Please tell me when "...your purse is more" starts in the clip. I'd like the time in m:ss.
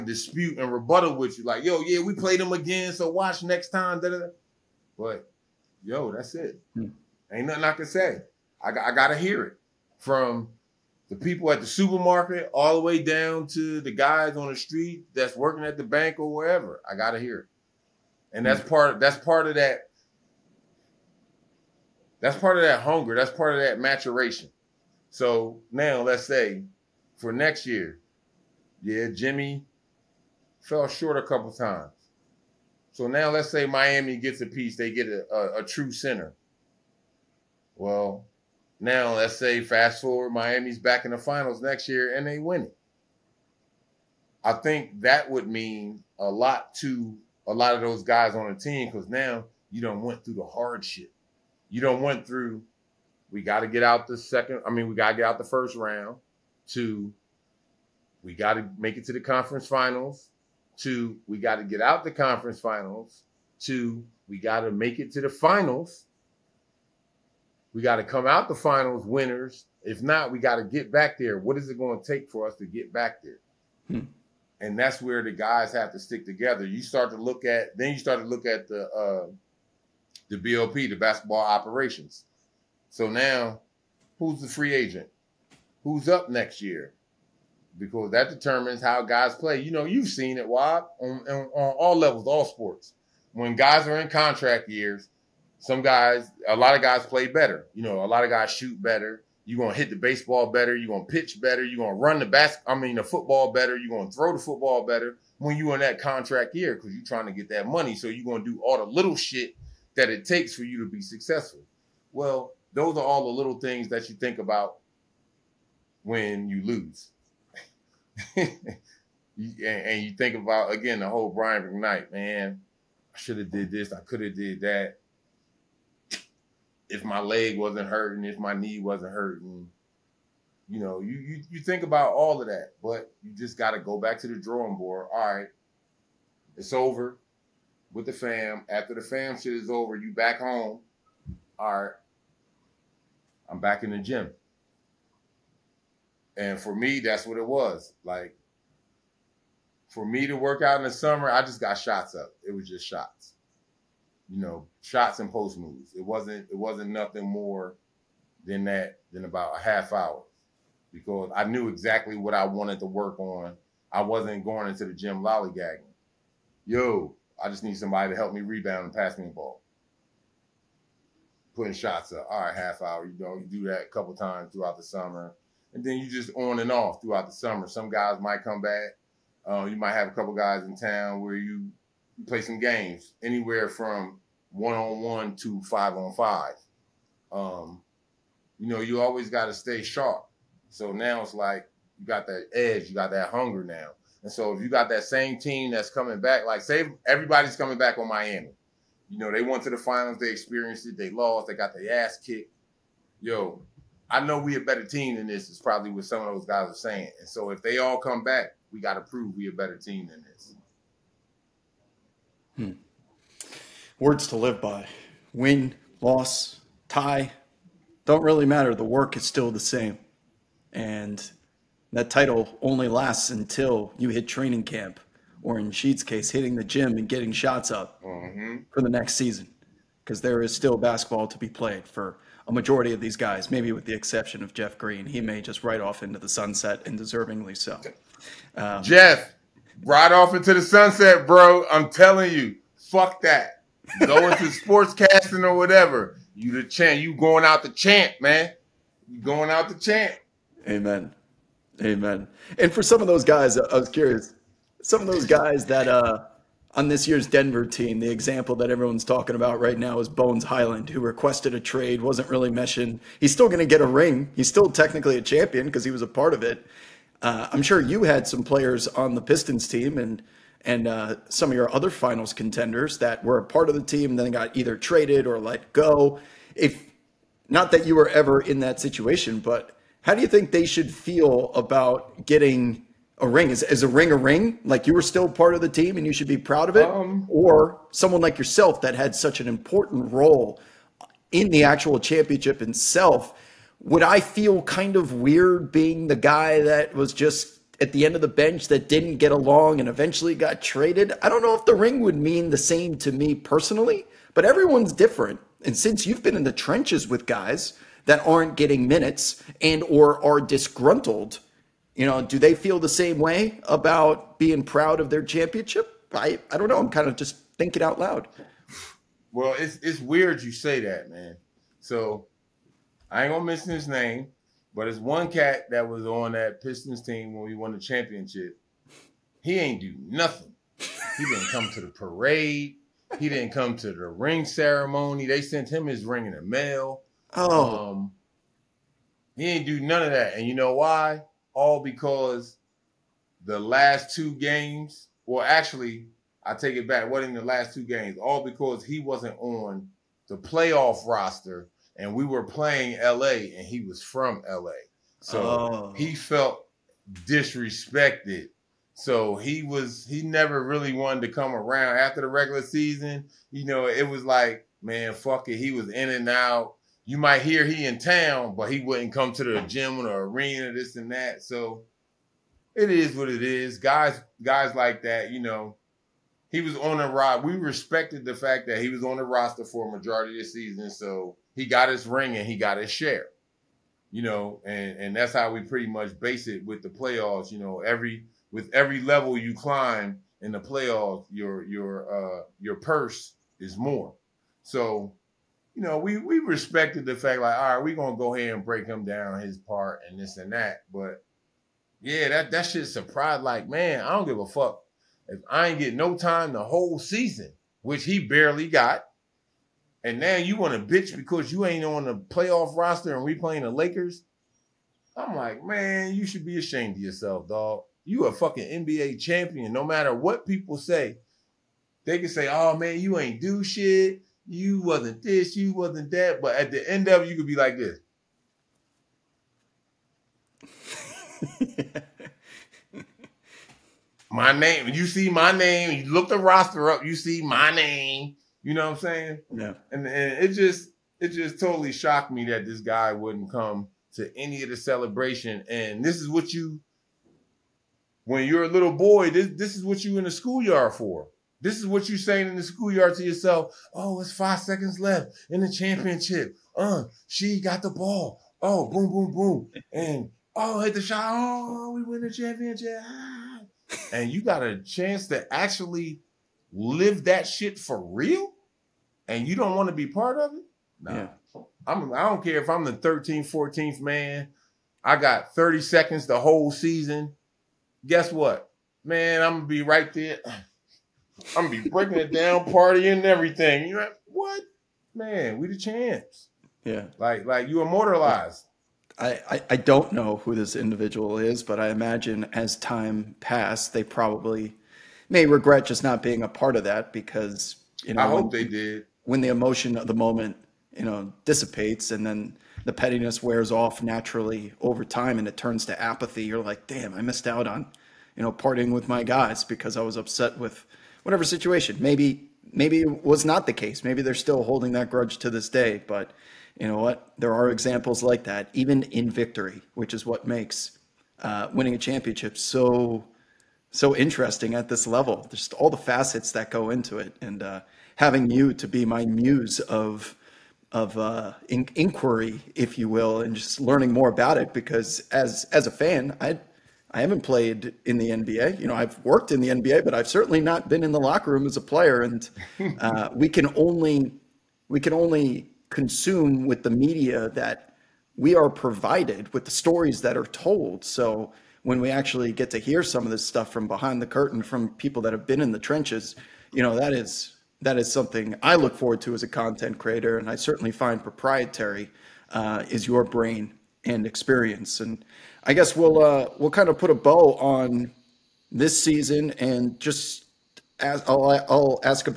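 6:32.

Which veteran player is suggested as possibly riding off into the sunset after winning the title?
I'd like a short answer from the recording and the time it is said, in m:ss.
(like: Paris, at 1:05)
Jeff Green, at 3:54.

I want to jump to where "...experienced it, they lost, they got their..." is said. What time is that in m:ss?
3:20.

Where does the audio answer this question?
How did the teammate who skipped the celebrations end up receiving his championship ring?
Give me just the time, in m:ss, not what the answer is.
5:36.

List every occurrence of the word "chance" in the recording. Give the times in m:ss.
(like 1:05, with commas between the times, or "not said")
7:44.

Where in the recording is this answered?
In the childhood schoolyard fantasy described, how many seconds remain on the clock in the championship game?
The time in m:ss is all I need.
7:34.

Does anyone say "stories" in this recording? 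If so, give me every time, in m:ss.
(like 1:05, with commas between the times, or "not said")
9:09.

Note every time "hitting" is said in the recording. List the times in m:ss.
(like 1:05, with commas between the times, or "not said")
3:46.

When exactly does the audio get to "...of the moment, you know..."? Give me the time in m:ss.
8:19.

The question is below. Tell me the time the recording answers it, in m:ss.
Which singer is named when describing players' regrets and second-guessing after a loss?
2:01.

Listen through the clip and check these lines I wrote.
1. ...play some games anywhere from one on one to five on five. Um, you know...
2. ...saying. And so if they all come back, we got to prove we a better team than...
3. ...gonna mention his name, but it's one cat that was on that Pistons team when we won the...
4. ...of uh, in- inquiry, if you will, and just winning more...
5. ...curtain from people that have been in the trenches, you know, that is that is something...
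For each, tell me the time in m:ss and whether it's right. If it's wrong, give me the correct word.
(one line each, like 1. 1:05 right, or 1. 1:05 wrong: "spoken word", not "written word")
1. 3:02 right
2. 3:26 right
3. 5:23 right
4. 8:50 wrong: "learning", not "winning"
5. 9:14 right.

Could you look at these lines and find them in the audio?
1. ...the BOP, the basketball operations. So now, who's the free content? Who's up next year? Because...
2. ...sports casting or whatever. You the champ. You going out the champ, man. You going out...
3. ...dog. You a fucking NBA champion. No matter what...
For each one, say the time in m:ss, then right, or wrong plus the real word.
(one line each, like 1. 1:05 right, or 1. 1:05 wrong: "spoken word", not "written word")
1. 1:20 wrong: "agent", not "content"
2. 4:04 right
3. 6:57 right.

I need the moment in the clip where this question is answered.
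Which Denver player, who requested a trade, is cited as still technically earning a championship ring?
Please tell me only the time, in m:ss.
4:20.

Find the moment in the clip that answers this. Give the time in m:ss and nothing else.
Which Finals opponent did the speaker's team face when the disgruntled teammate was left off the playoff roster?
6:53.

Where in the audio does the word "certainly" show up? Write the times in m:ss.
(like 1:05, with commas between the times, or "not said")
9:00, 9:20.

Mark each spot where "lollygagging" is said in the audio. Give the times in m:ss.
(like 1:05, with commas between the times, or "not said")
2:45.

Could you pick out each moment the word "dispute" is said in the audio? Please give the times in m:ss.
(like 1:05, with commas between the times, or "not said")
0:00.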